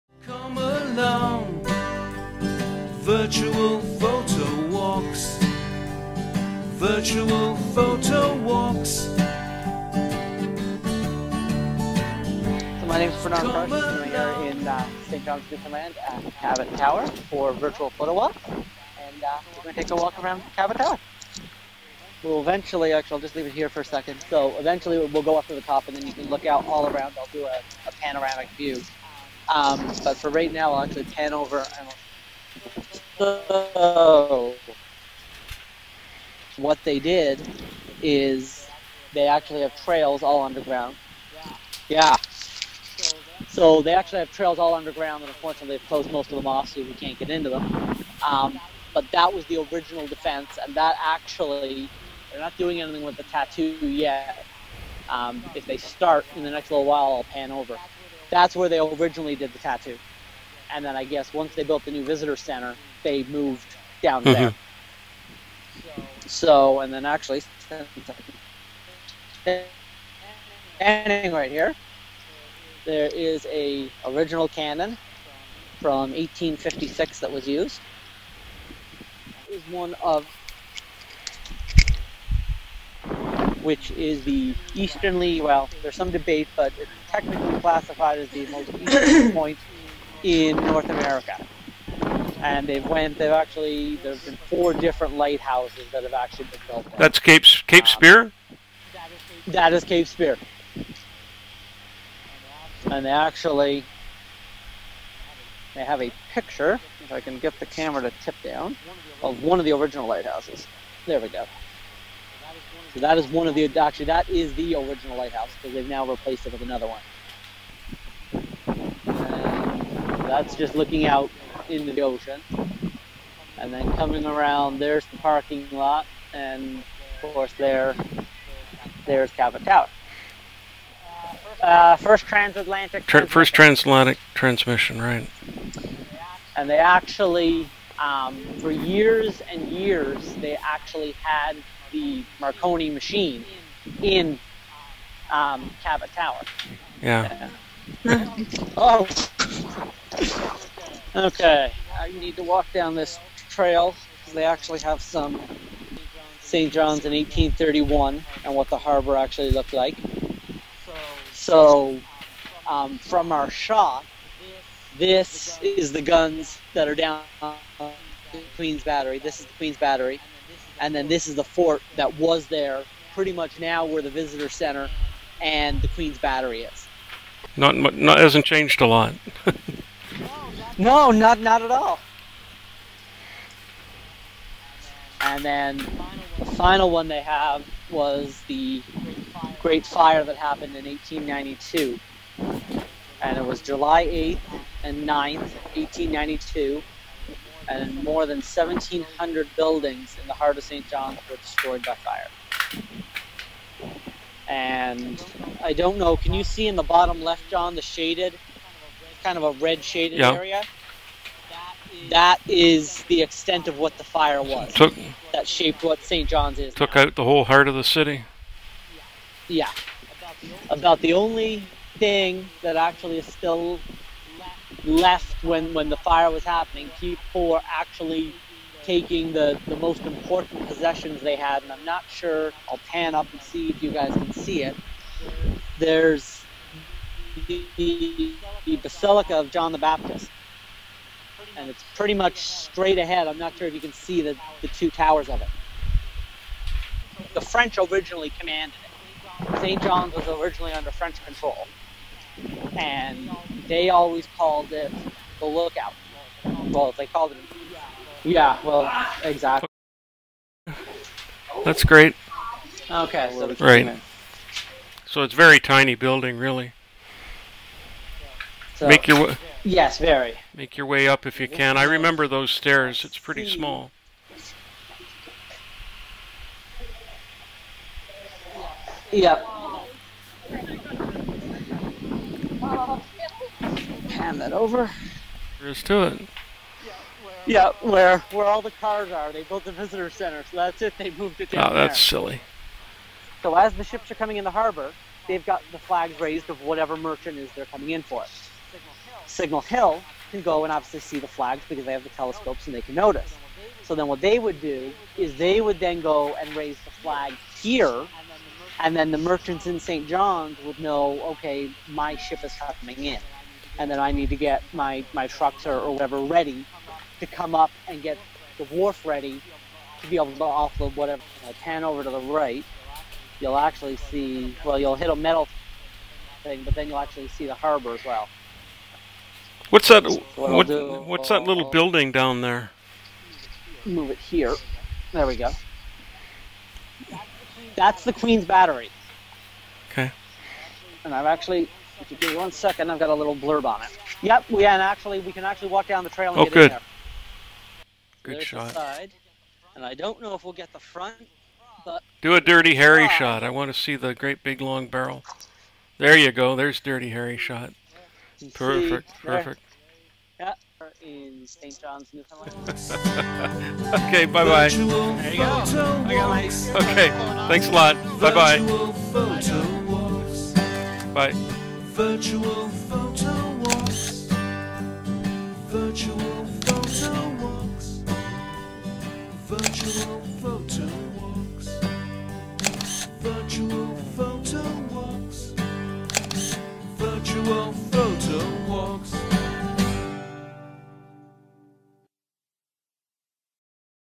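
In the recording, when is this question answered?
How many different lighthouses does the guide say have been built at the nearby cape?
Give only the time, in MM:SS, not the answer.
01:34.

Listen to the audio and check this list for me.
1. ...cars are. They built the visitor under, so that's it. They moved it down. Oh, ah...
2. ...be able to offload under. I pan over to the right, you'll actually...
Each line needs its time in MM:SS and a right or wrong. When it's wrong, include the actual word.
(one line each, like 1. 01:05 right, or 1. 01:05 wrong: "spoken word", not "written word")
1. 04:48 wrong: "center", not "under"
2. 05:20 wrong: "whatever", not "under".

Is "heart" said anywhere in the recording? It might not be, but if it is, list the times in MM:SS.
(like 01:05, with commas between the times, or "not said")
03:20, 03:37.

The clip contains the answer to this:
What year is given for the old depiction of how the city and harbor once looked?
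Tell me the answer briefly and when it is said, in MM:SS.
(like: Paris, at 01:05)
1831, at 02:37.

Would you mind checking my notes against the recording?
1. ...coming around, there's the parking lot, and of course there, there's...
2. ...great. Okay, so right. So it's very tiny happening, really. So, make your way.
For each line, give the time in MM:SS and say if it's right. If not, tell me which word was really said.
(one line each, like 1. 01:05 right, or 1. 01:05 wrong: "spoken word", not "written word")
1. 02:03 right
2. 04:21 wrong: "building", not "happening".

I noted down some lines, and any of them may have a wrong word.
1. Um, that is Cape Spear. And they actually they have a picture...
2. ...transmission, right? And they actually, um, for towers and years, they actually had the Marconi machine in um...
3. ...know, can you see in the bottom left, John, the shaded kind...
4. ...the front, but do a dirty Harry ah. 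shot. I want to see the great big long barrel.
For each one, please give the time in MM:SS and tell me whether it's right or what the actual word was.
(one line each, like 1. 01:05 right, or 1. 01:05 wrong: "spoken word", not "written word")
1. 01:38 right
2. 02:14 wrong: "years", not "towers"
3. 03:25 right
4. 05:50 right.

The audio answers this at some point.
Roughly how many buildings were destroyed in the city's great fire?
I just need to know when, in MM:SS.
03:18.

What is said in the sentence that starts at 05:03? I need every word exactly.
So then what they would do is they would then go and raise the flag here, and then the merchants in St.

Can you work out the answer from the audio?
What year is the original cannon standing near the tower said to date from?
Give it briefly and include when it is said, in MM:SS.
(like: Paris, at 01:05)
1856, at 01:16.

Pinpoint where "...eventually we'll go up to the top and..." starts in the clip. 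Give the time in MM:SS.
00:24.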